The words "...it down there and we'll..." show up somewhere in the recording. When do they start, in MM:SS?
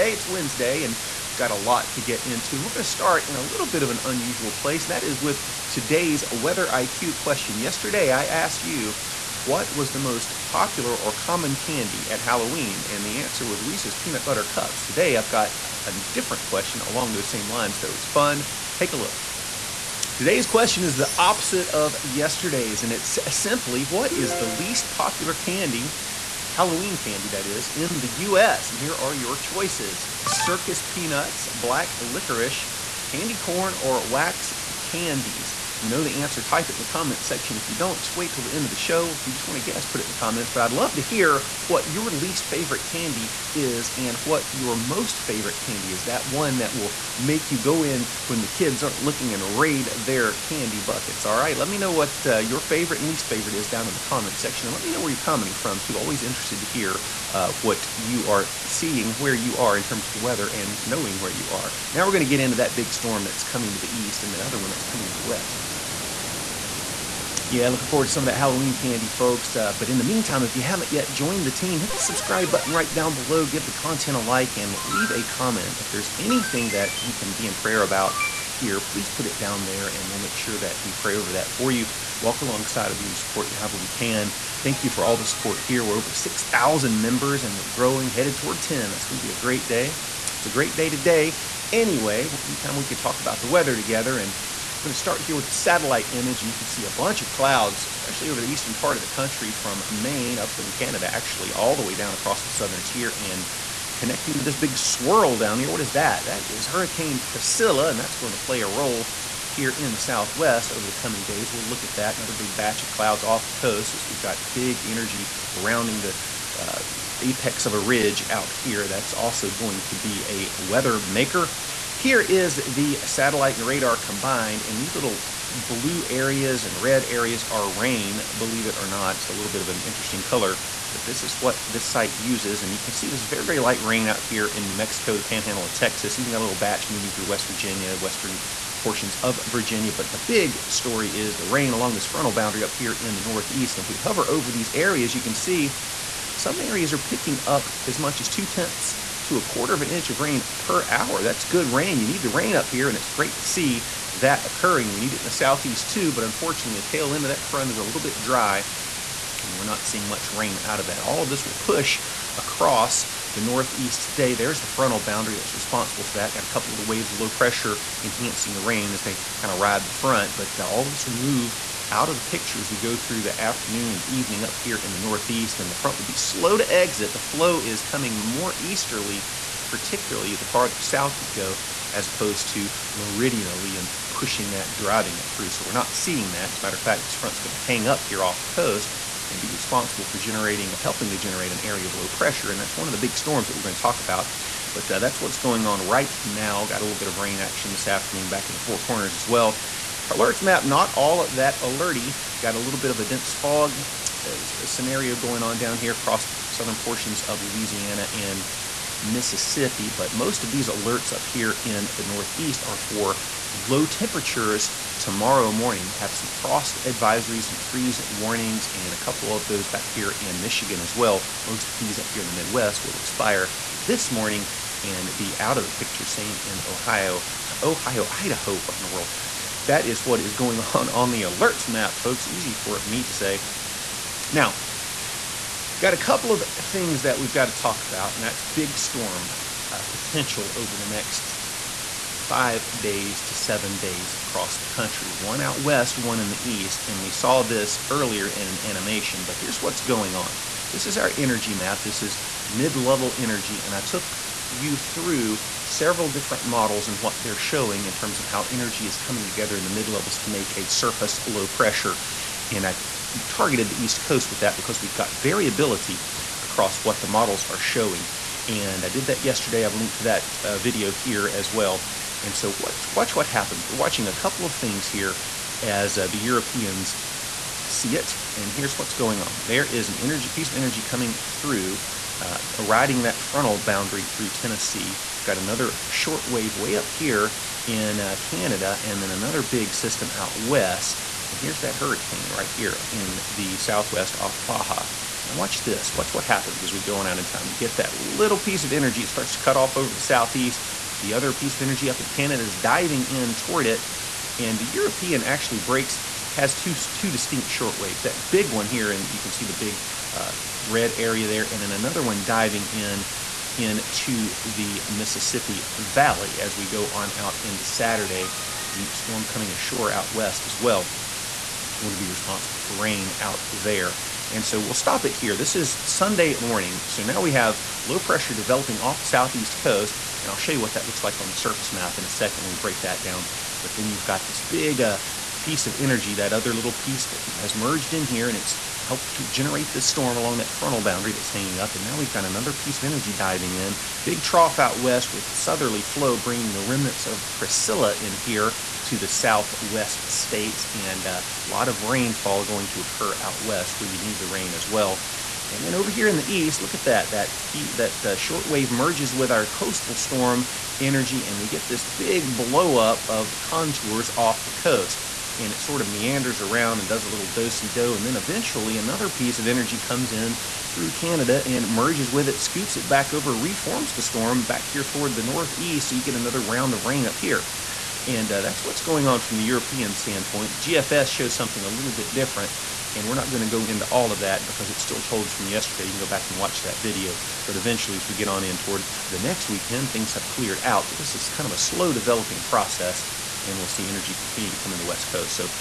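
01:19.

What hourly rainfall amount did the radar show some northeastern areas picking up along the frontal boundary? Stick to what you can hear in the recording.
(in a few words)
a quarter of an inch.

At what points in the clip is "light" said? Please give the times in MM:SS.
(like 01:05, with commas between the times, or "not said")
02:13.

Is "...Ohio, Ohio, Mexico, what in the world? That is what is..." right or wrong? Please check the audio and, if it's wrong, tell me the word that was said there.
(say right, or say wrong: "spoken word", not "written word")
wrong: "Idaho", not "Mexico".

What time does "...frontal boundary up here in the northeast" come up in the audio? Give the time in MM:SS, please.
02:22.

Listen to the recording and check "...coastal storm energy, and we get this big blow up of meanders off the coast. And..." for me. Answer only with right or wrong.
wrong.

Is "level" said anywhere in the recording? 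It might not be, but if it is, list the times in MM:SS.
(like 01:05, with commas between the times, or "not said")
04:12, 04:19.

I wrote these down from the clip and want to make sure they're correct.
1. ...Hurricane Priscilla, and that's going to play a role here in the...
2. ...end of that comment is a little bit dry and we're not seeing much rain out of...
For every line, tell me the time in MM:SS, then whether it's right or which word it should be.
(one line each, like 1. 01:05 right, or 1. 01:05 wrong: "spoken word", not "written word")
1. 01:46 right
2. 02:37 wrong: "front", not "comment".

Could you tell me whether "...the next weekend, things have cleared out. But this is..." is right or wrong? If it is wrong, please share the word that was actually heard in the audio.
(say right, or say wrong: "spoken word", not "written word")
right.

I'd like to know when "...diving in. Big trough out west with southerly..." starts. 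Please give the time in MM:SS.
05:43.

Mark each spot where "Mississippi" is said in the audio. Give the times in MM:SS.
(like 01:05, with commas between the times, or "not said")
03:29, 05:14.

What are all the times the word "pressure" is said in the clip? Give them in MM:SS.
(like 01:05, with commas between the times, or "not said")
02:47, 03:12, 04:21, 05:27.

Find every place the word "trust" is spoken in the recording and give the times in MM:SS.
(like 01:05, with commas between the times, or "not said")
not said.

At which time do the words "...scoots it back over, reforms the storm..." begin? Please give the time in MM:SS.
06:12.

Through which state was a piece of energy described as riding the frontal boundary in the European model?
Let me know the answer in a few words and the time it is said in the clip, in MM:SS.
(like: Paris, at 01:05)
Tennessee, at 04:44.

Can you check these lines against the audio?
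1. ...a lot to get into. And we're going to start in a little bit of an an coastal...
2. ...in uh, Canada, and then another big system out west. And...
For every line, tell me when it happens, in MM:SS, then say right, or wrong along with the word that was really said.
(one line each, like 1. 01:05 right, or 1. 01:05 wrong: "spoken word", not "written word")
1. 00:01 wrong: "unusual", not "coastal"
2. 04:47 right.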